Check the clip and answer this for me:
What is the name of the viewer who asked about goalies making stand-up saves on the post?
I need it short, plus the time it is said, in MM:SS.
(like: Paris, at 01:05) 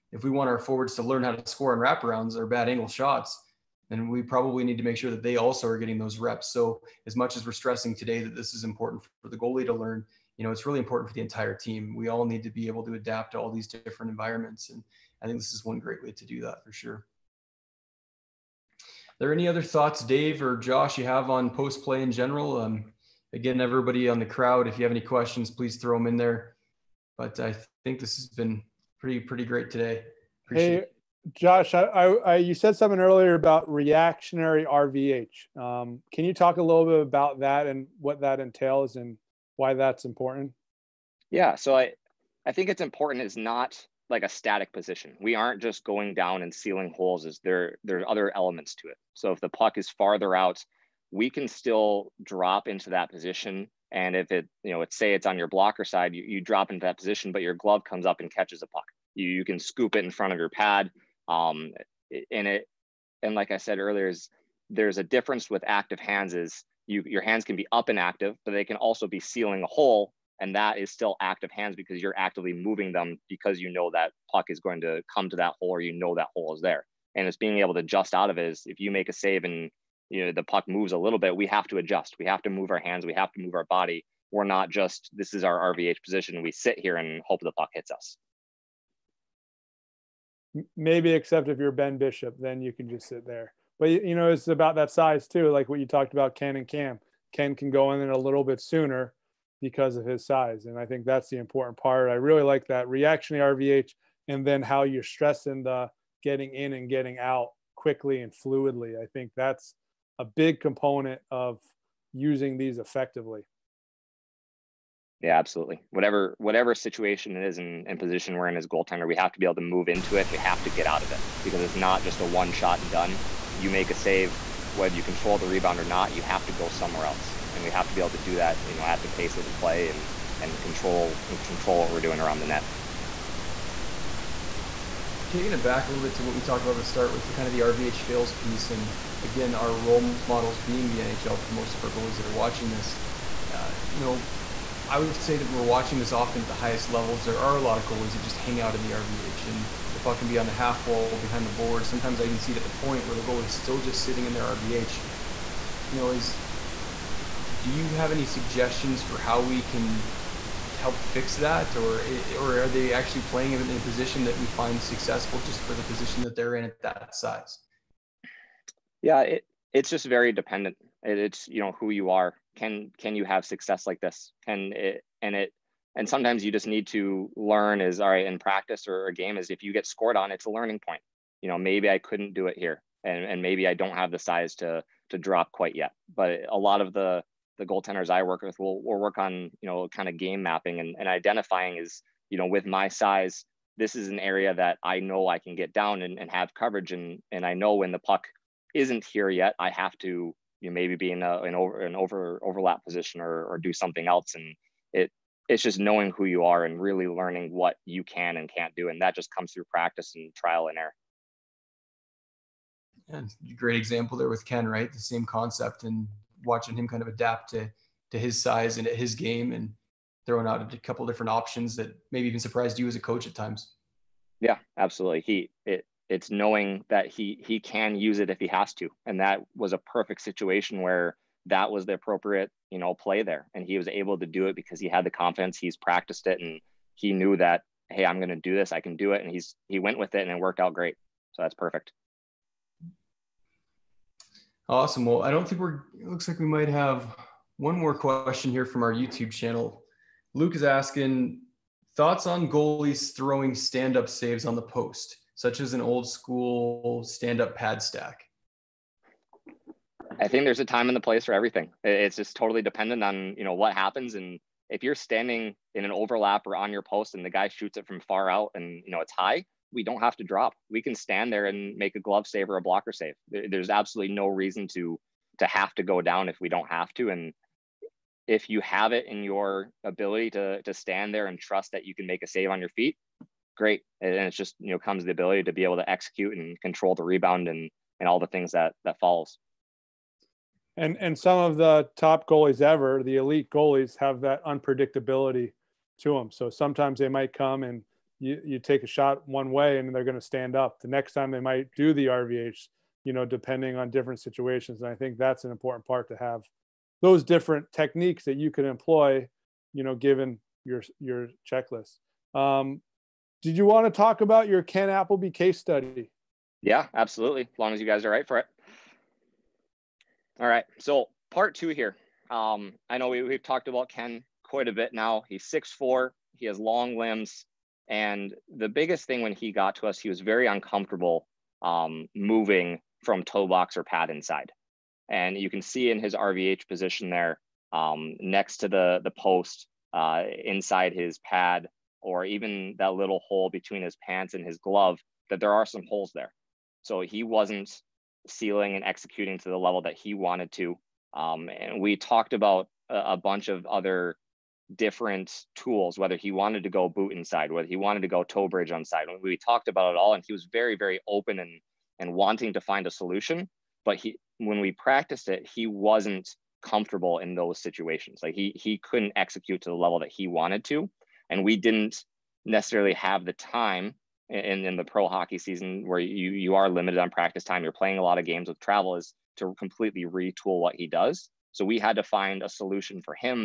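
Luke, at 04:10.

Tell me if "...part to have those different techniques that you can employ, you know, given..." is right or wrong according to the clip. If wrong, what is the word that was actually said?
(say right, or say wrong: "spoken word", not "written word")
right.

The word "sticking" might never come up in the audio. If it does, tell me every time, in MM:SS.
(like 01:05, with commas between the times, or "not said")
not said.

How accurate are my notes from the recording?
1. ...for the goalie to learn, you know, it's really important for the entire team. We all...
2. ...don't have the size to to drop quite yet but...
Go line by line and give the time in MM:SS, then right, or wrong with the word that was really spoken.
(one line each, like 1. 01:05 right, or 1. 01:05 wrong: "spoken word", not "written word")
1. 00:09 right
2. 03:03 right.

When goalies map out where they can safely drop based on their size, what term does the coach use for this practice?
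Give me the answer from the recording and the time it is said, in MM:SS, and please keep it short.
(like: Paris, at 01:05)
game mapping, at 03:10.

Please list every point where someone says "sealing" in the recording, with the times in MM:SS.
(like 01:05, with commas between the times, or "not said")
00:46, 01:09, 05:48.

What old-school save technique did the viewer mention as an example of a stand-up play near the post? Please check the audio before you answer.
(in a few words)
pad stack.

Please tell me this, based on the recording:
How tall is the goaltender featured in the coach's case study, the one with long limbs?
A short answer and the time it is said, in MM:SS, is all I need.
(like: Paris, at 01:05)
6'4", at 05:25.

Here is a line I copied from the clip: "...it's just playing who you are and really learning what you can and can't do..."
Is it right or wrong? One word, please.
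wrong.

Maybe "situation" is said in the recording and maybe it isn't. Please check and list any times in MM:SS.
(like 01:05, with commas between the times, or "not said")
01:56, 03:50, 05:04, 06:07.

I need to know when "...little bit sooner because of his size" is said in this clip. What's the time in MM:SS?
01:38.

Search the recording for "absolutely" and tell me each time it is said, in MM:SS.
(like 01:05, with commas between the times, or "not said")
01:55, 03:44, 04:33, 05:16.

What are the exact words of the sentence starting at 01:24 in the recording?
We're not just this is our RVH position.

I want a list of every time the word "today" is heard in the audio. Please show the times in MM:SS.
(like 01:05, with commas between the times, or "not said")
00:07, 00:29.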